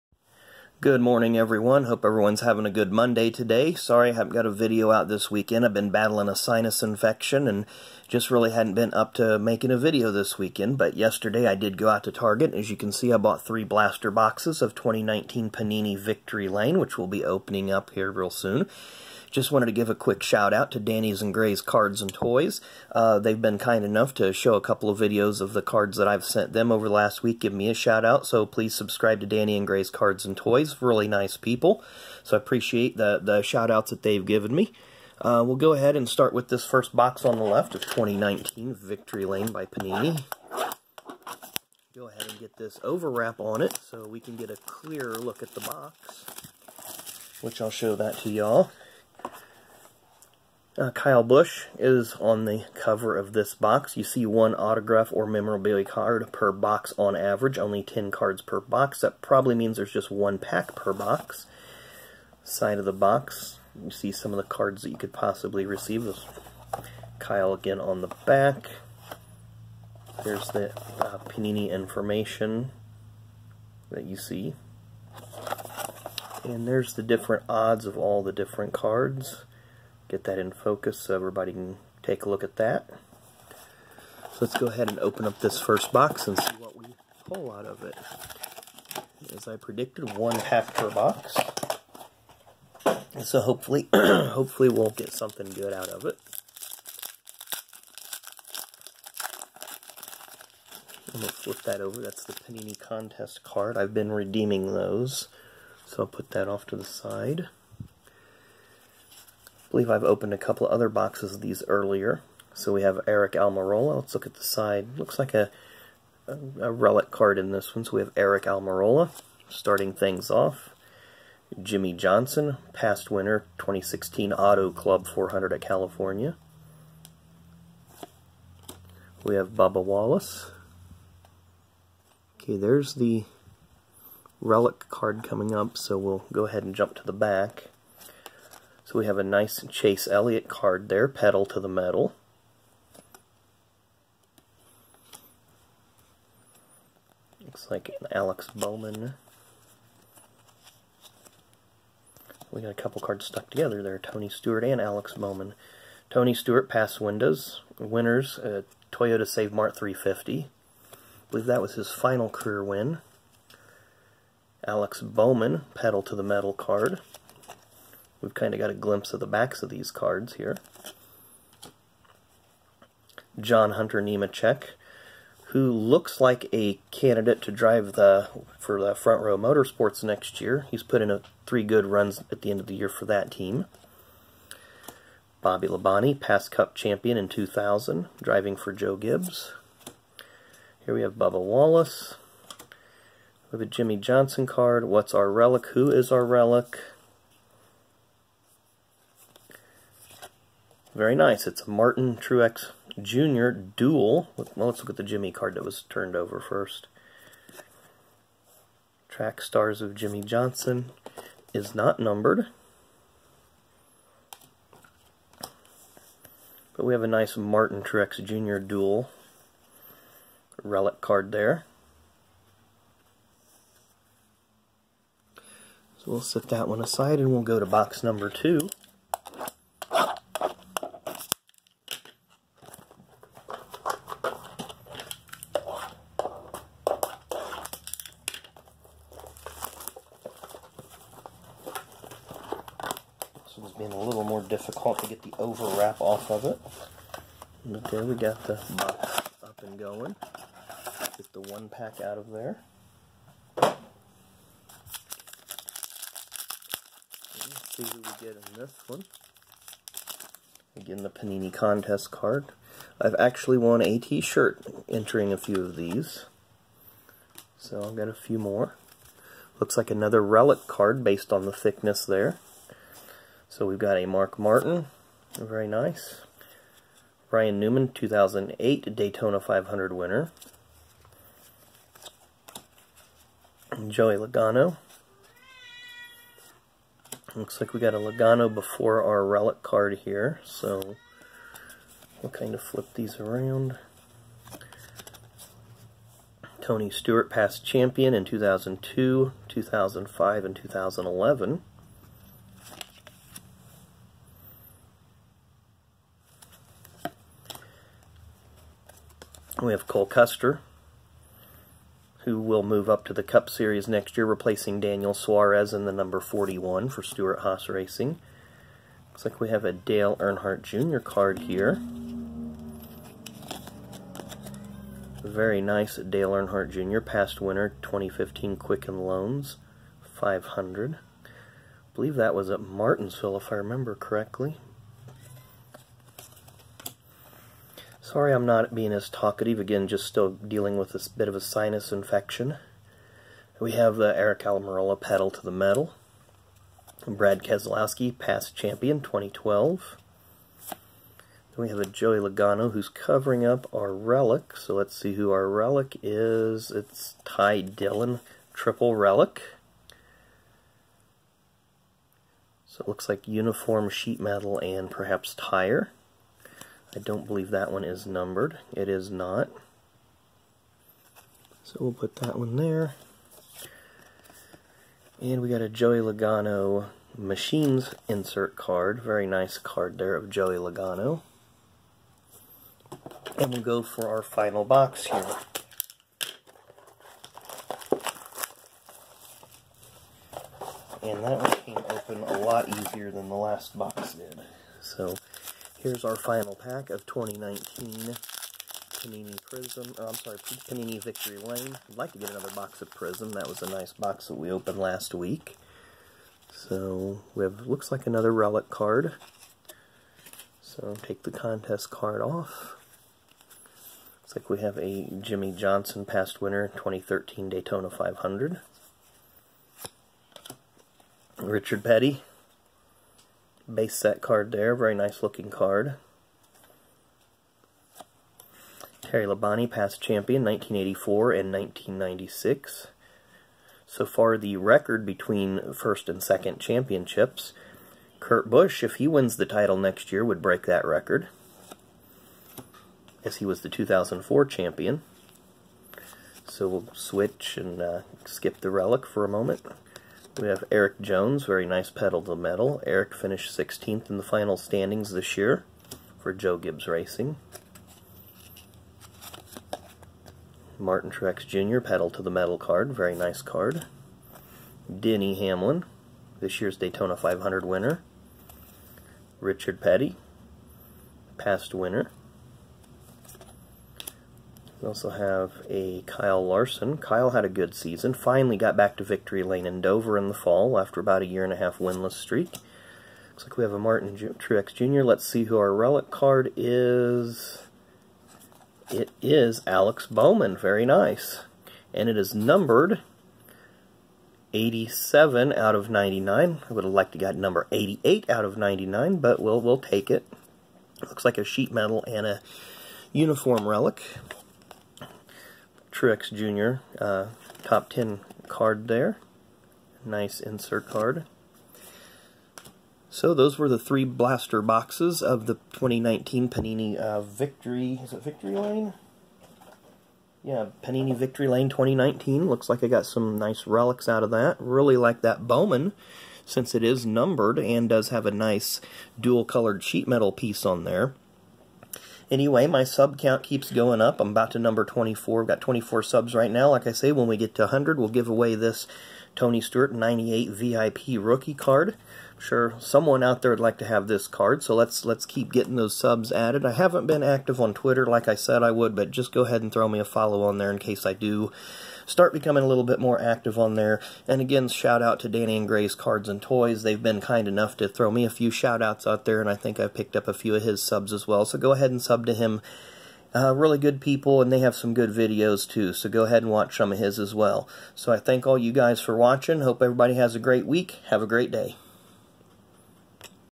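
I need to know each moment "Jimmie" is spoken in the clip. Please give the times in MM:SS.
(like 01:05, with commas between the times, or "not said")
02:01, 03:13, 03:25, 03:29, 06:55.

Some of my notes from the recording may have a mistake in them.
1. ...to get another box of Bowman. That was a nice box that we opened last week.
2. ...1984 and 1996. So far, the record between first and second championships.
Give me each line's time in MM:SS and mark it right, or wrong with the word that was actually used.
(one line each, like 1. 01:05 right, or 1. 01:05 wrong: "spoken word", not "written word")
1. 06:42 wrong: "Prism", not "Bowman"
2. 07:10 right.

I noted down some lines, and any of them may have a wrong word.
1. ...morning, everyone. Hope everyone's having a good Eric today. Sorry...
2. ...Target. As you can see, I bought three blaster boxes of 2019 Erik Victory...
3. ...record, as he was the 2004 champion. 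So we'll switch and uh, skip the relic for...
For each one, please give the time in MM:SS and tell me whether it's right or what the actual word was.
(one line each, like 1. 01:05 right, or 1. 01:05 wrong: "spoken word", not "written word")
1. 00:01 wrong: "Monday", not "Eric"
2. 00:12 wrong: "Panini", not "Erik"
3. 07:20 right.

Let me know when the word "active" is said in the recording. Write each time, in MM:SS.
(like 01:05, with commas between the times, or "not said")
09:07, 09:13.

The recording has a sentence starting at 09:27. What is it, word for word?
So I thank all you guys for watching.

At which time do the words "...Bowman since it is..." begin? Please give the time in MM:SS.
08:45.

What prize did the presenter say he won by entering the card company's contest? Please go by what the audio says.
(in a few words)
A t-shirt.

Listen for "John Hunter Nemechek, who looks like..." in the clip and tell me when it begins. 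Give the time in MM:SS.
02:53.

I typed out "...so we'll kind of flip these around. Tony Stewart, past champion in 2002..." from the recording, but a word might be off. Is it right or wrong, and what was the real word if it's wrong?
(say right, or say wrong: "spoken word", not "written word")
right.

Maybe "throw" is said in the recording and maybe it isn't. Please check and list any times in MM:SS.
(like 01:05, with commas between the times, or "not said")
09:09, 09:17.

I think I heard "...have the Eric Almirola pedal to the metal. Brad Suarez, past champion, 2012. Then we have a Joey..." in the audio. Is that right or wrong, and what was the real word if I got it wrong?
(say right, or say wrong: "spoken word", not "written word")
wrong: "Keselowski", not "Suarez".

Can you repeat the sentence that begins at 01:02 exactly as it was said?
Side of the box, you see some of the cards that you could possibly receive.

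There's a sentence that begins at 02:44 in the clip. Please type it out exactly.
Alex Bowman, pedal to the metal card.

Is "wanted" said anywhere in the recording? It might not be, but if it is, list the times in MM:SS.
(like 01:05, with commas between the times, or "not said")
00:19.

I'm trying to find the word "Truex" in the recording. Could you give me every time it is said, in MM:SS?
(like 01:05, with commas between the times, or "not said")
03:22, 03:37, 07:41, 08:04, 08:26.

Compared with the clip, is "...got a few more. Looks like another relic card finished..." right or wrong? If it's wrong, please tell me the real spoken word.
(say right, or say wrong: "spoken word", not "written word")
wrong: "based", not "finished".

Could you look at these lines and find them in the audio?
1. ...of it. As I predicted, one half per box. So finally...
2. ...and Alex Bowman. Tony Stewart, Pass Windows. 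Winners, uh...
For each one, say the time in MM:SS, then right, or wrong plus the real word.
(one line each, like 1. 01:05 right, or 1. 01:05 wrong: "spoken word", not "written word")
1. 01:27 wrong: "hopefully", not "finally"
2. 02:34 right.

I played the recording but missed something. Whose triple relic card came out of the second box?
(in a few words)
Ty Dillon.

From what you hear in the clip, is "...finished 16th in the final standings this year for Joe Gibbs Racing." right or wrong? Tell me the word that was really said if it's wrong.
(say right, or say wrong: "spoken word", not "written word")
right.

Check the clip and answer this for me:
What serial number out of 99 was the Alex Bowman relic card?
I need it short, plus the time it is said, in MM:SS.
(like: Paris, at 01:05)
87, at 08:14.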